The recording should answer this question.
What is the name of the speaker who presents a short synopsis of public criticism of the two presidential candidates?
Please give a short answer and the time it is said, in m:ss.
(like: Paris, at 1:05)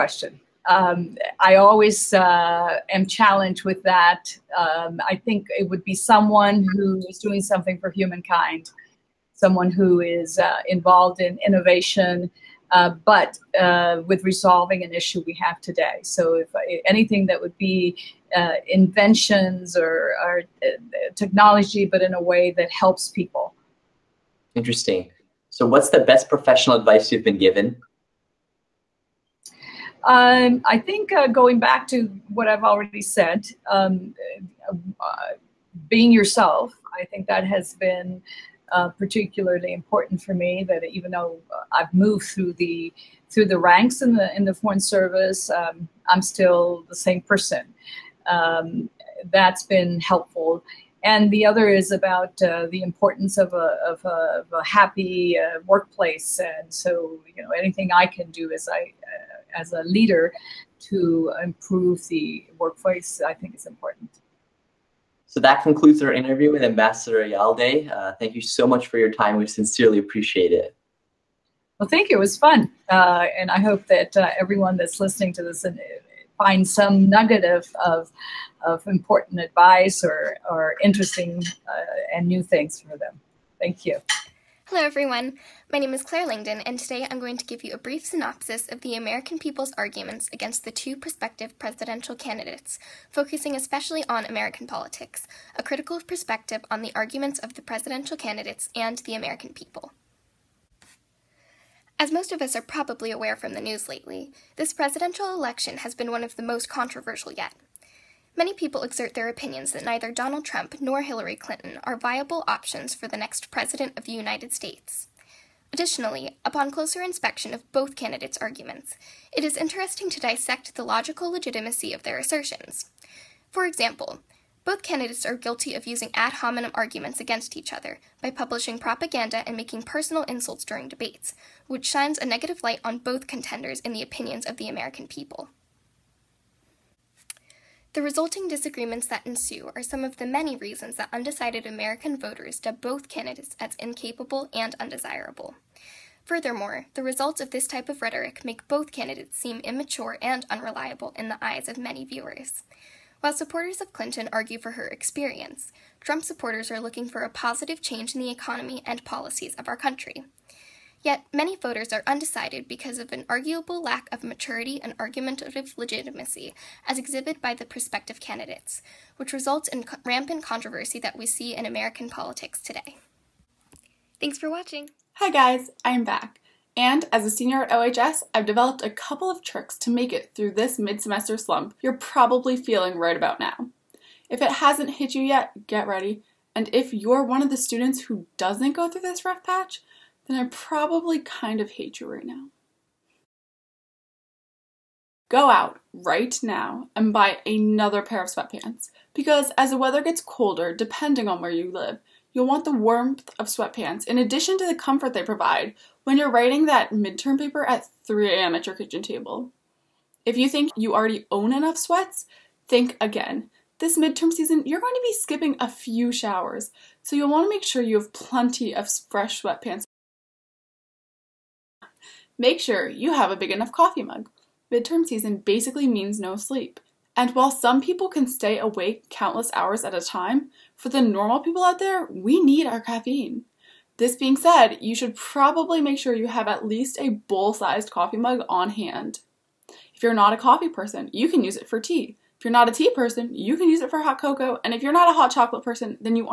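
Claire Langdon, at 1:26.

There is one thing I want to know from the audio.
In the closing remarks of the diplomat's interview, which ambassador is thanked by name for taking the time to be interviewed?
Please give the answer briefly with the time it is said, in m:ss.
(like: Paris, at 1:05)
Ayalde, at 1:06.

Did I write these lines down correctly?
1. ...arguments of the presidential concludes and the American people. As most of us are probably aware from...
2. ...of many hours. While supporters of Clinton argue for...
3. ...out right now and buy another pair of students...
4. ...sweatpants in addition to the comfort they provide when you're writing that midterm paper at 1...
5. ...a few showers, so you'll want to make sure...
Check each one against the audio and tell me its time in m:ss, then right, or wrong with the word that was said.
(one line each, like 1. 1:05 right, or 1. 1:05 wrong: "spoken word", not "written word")
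1. 1:36 wrong: "candidates", not "concludes"
2. 2:31 wrong: "viewers", not "hours"
3. 3:15 wrong: "sweatpants", not "students"
4. 3:23 wrong: "3", not "1"
5. 3:35 right.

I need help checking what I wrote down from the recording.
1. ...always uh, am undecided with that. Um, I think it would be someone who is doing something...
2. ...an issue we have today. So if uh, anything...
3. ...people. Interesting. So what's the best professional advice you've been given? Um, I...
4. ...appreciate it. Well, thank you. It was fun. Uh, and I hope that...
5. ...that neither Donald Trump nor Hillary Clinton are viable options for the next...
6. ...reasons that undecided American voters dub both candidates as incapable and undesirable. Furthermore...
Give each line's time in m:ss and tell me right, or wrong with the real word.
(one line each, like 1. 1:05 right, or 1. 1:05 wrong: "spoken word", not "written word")
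1. 0:01 wrong: "challenged", not "undecided"
2. 0:14 right
3. 0:23 right
4. 1:09 right
5. 1:49 right
6. 2:20 right.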